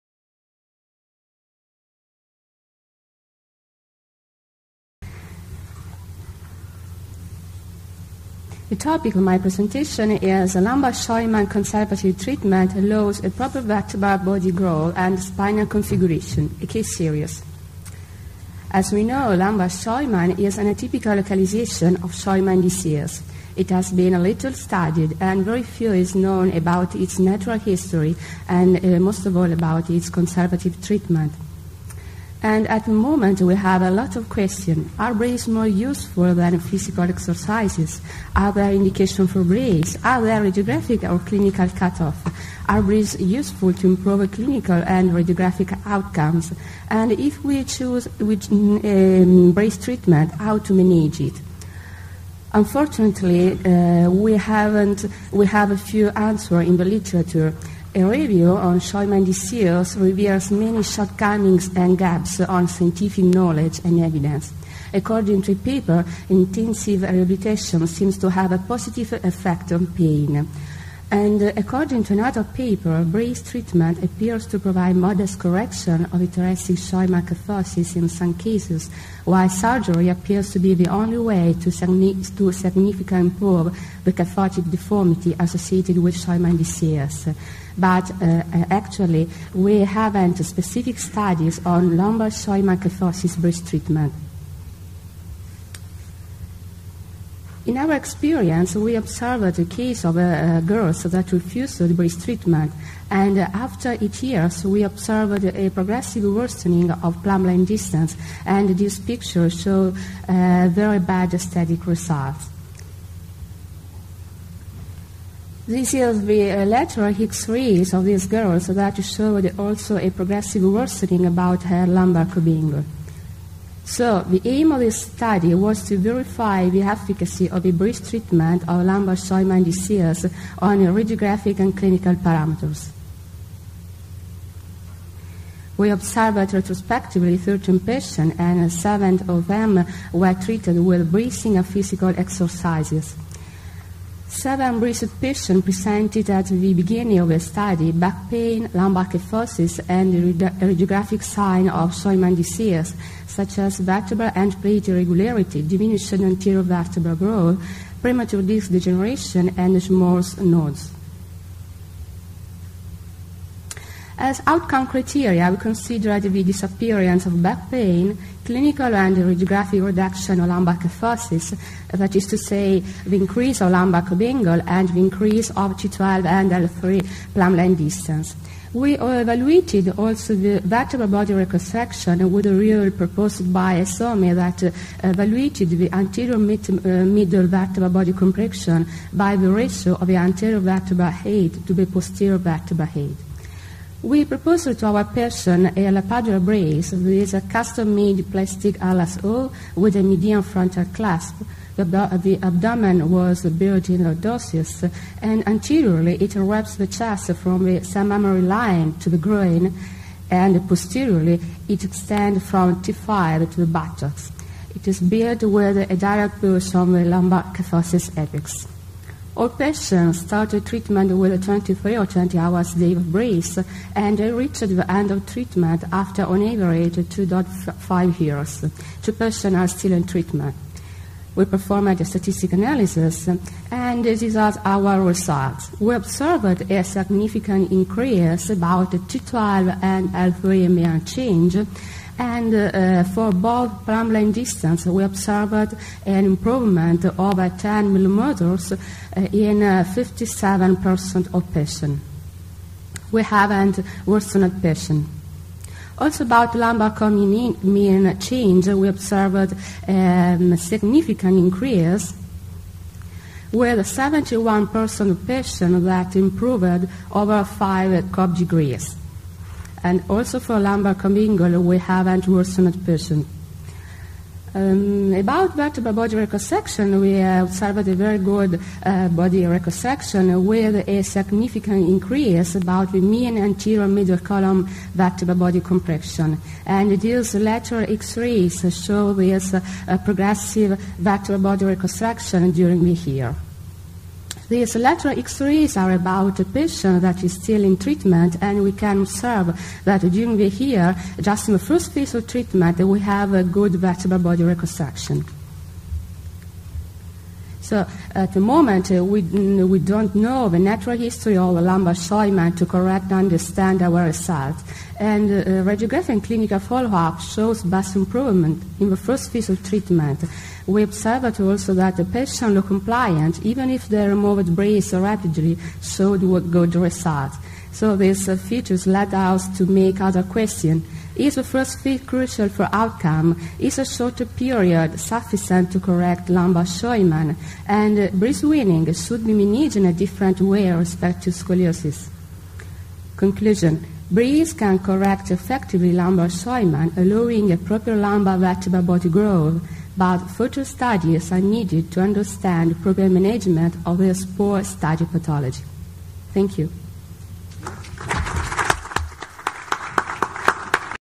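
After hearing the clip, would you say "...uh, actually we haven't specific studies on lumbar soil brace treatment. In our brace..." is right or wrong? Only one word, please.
wrong.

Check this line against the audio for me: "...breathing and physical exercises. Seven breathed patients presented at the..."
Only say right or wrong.
right.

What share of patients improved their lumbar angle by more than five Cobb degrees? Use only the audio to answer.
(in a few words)
71%.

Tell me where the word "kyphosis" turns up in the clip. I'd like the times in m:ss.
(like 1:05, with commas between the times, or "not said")
1:17, 2:29, 2:50, 3:37.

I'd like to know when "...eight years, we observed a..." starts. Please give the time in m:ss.
1:44.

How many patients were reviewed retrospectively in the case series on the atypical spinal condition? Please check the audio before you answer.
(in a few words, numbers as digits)
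13.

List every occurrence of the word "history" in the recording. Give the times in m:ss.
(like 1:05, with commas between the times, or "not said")
0:27, 5:10.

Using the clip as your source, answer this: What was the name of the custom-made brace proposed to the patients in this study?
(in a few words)
Lapadula brace.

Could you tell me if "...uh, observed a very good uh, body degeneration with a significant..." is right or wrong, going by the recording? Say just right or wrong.
wrong.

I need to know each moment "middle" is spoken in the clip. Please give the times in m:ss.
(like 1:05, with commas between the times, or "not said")
3:07, 4:43.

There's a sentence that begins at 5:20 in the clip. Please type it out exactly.
We observed also that the patient looked compliant, even if they removed brace rapidly, showed good results.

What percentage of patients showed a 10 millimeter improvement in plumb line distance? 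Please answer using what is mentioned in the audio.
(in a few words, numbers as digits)
57%.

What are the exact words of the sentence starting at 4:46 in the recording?
And these lateral X-rays show this uh, progressive vertebral body reconstruction during the year.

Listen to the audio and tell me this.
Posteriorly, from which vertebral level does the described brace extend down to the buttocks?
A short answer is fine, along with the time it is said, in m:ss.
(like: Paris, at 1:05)
T5, at 3:32.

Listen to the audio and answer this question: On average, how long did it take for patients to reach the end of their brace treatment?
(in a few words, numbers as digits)
2.5 years.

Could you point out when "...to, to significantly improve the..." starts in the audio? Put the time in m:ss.
1:21.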